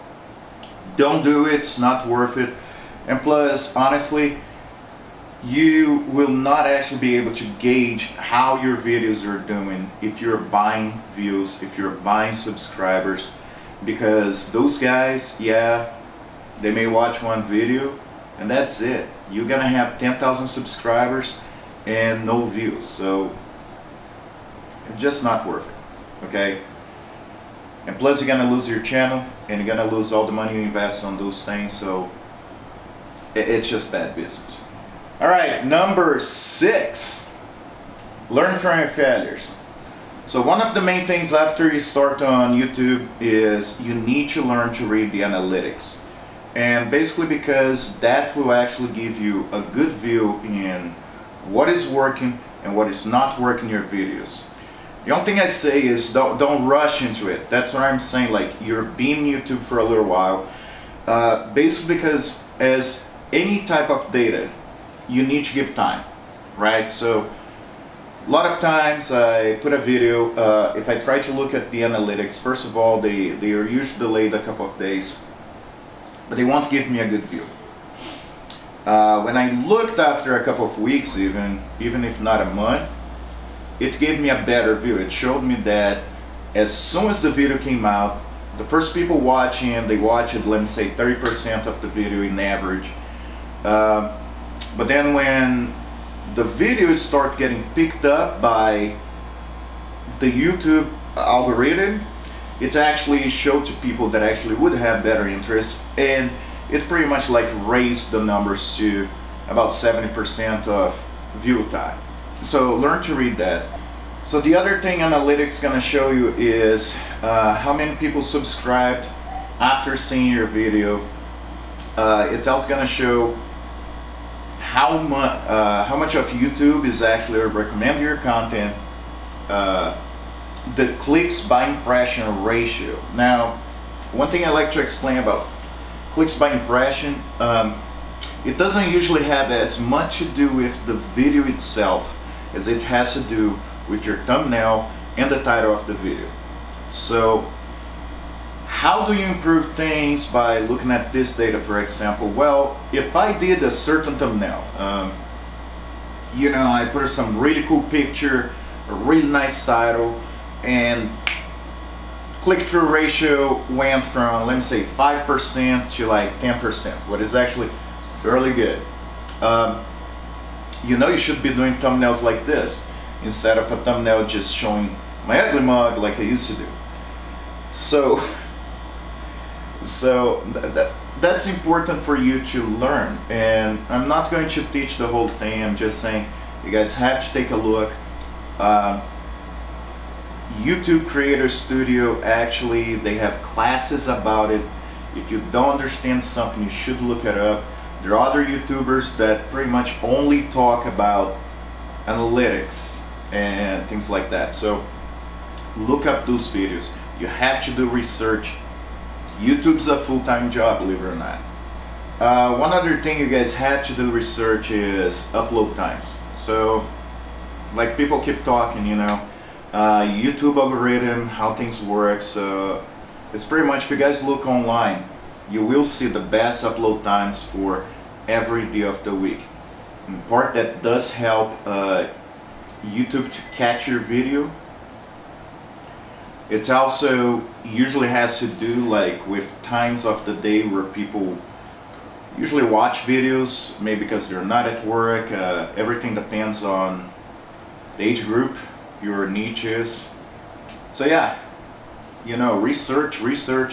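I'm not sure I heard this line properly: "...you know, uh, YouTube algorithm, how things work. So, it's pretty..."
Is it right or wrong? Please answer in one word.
right.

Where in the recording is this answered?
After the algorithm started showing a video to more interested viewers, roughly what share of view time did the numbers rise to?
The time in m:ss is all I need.
1:49.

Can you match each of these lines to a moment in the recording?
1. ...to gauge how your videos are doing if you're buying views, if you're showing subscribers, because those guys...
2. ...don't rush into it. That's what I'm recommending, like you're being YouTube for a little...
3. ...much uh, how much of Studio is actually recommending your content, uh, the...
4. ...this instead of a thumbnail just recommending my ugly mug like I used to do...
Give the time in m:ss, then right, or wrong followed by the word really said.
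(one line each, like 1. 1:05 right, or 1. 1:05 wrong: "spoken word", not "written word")
1. 0:07 wrong: "buying", not "showing"
2. 0:56 wrong: "saying", not "recommending"
3. 2:04 wrong: "YouTube", not "Studio"
4. 2:52 wrong: "showing", not "recommending".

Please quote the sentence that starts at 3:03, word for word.
And I'm not going to teach the whole thing.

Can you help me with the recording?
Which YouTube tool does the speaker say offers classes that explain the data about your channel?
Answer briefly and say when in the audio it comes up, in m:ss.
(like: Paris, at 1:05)
YouTube Creator Studio, at 3:10.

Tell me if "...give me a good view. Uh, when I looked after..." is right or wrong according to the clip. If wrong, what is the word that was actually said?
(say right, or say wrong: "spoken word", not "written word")
right.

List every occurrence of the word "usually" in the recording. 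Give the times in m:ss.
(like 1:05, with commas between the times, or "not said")
1:13, 2:18, 3:57, 4:02.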